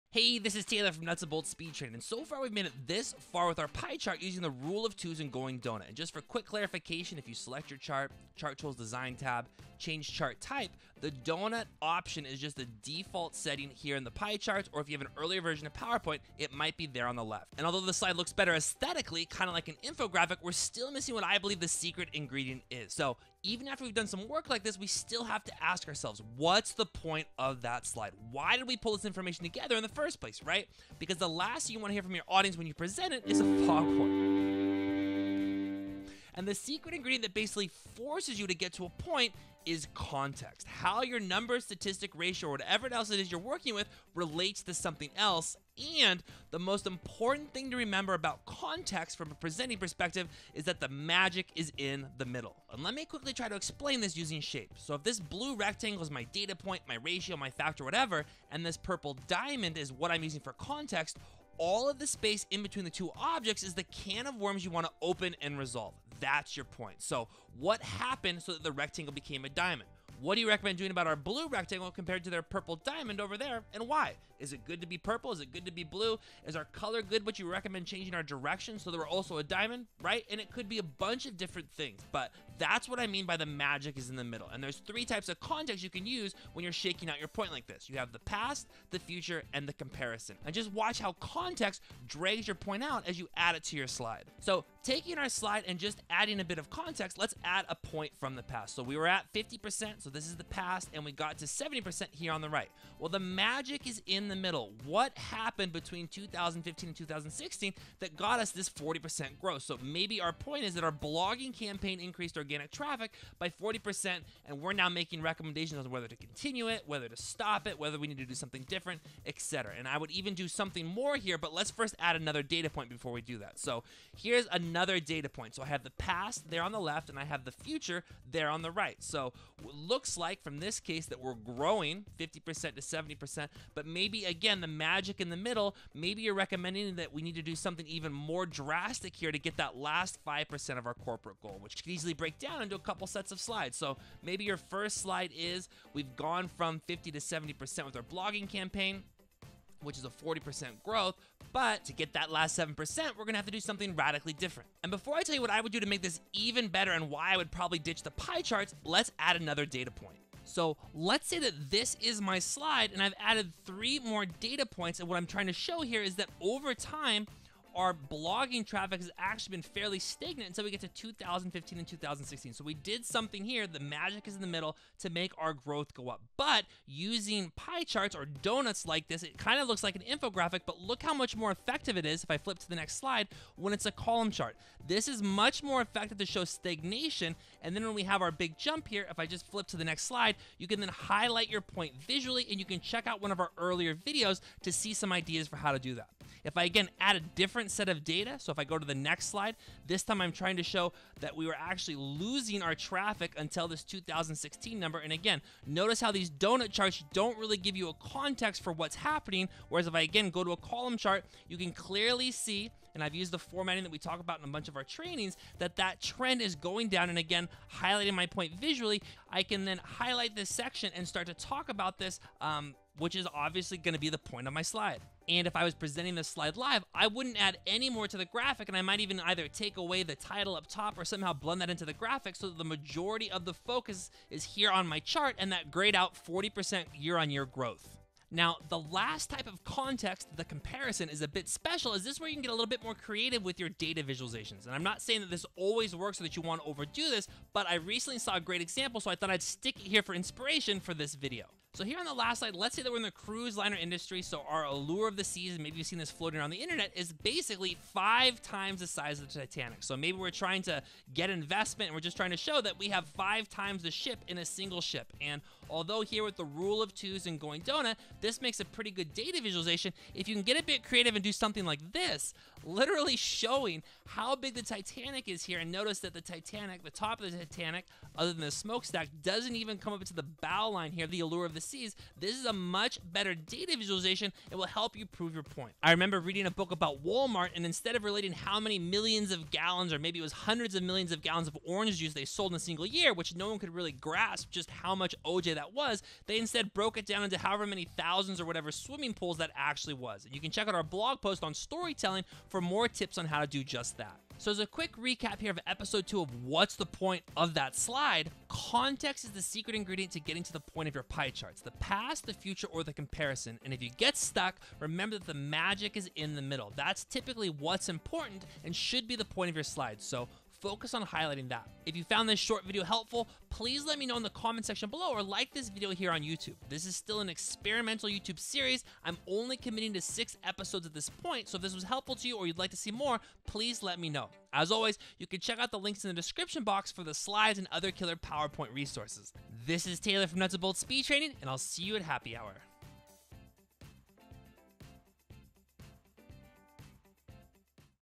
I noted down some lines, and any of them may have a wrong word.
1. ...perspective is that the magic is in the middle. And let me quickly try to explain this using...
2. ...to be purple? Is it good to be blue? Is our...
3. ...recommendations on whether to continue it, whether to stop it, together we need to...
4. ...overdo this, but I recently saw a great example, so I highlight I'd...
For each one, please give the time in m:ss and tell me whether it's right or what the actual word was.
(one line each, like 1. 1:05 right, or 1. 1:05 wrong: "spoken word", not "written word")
1. 0:49 right
2. 1:14 right
3. 1:55 wrong: "whether", not "together"
4. 4:06 wrong: "thought", not "highlight".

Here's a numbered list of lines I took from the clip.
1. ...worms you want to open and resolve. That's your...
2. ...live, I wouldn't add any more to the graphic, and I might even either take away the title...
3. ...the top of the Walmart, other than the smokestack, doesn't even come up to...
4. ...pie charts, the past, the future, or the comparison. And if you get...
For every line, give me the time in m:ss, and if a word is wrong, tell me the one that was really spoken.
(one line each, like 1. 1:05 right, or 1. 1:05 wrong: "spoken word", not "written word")
1. 1:04 right
2. 3:46 right
3. 4:36 wrong: "Titanic", not "Walmart"
4. 5:11 right.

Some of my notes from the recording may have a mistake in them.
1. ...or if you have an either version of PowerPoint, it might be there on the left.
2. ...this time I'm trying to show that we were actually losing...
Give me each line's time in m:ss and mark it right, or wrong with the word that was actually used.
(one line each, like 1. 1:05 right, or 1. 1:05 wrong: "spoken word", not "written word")
1. 0:14 wrong: "earlier", not "either"
2. 3:19 right.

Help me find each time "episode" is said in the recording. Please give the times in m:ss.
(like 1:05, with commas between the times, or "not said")
5:05, 5:30.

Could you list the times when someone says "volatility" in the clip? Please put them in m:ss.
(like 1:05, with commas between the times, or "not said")
not said.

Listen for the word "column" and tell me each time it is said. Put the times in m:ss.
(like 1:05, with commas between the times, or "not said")
3:03, 3:30.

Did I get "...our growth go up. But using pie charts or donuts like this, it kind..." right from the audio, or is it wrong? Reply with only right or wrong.
right.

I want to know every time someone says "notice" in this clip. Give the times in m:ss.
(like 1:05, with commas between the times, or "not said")
3:25, 4:35.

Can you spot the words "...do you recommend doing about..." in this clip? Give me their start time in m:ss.
1:10.